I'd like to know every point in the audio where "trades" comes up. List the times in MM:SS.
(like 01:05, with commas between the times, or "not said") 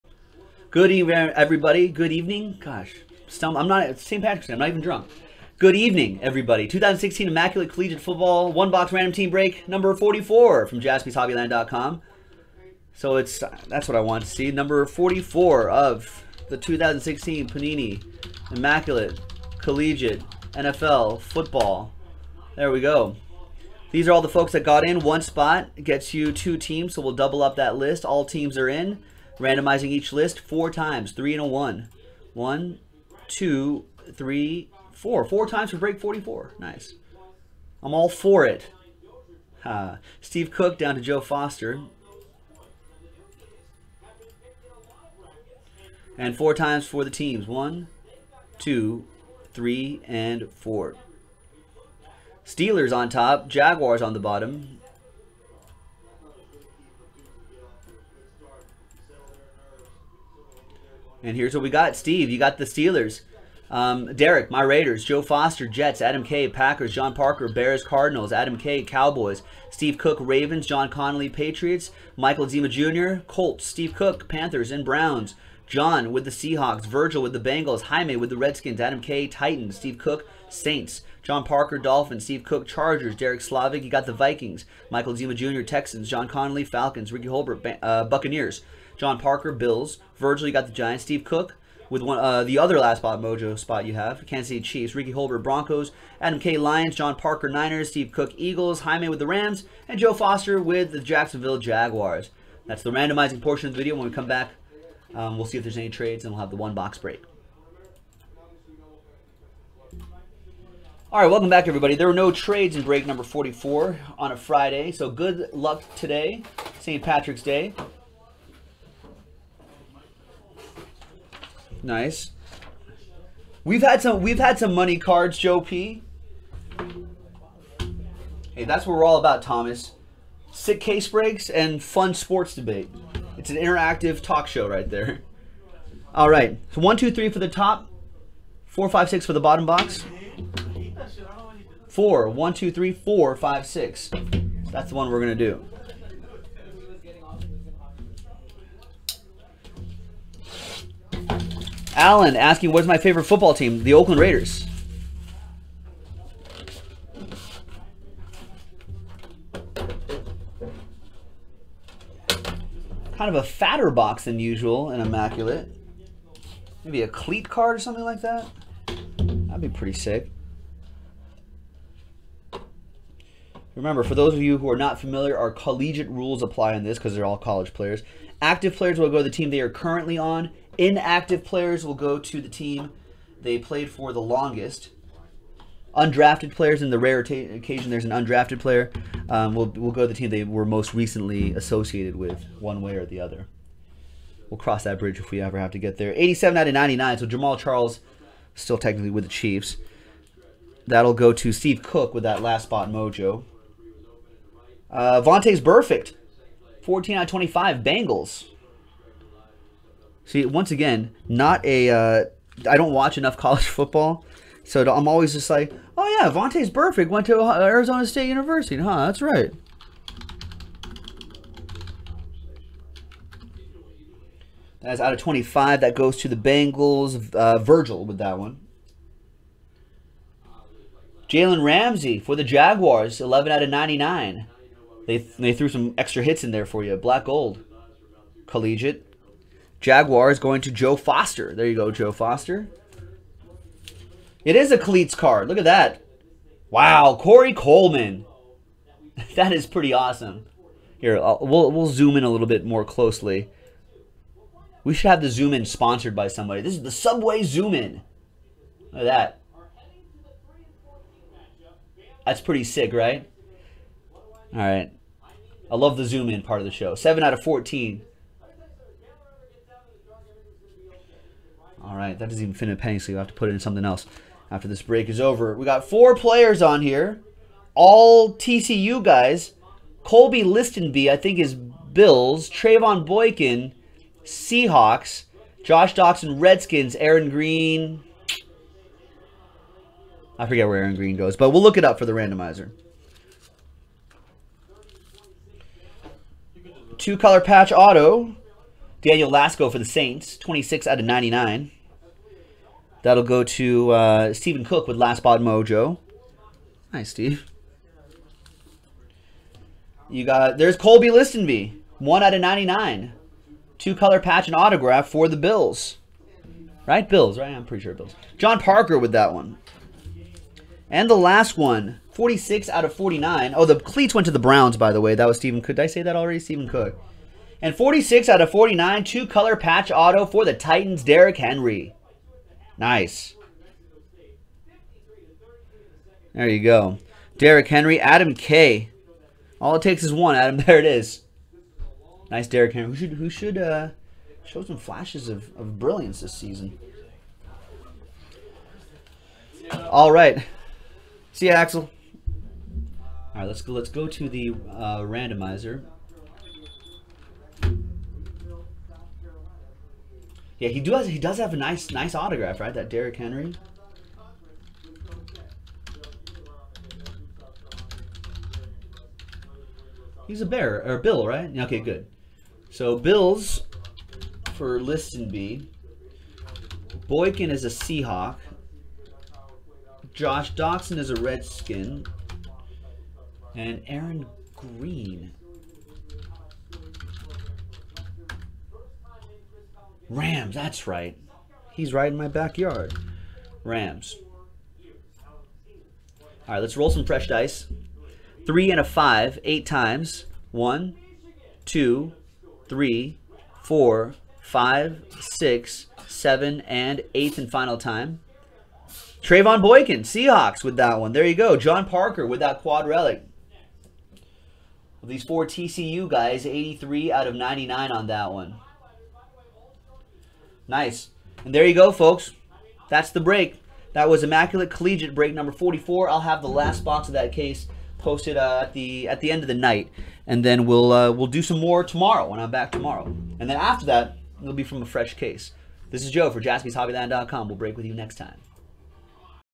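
01:45, 01:52.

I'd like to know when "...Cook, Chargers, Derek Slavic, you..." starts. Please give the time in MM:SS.
01:22.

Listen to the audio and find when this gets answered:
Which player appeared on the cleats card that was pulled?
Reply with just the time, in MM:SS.
04:07.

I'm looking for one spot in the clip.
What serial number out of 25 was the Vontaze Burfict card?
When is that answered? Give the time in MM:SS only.
03:26.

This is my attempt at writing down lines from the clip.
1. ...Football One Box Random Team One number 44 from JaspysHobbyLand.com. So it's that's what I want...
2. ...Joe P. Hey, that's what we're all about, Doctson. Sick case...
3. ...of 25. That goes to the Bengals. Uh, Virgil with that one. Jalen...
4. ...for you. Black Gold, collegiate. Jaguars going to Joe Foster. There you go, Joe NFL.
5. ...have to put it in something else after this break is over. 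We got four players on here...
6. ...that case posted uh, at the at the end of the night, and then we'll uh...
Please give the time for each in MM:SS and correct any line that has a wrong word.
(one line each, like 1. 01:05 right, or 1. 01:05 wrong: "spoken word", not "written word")
1. 00:07 wrong: "Break", not "One"
2. 02:05 wrong: "Thomas", not "Doctson"
3. 03:45 right
4. 03:56 wrong: "Foster", not "NFL"
5. 04:33 right
6. 07:07 right.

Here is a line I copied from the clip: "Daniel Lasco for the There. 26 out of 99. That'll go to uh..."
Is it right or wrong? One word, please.
wrong.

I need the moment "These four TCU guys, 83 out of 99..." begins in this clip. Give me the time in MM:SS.
06:55.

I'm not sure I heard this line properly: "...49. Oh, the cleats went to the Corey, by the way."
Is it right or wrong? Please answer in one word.
wrong.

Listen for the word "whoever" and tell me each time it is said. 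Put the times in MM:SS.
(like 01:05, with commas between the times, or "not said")
not said.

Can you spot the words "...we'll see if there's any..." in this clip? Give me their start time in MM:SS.
01:45.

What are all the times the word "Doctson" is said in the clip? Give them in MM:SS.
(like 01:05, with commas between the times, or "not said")
04:45, 06:20.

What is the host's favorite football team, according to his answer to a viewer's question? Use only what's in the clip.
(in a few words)
Oakland Raiders.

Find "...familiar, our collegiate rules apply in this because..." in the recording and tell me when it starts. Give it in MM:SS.
02:54.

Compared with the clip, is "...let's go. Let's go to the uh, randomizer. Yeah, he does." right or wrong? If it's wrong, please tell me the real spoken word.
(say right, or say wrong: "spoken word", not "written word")
right.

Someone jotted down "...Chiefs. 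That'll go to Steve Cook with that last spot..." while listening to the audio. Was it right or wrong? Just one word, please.
right.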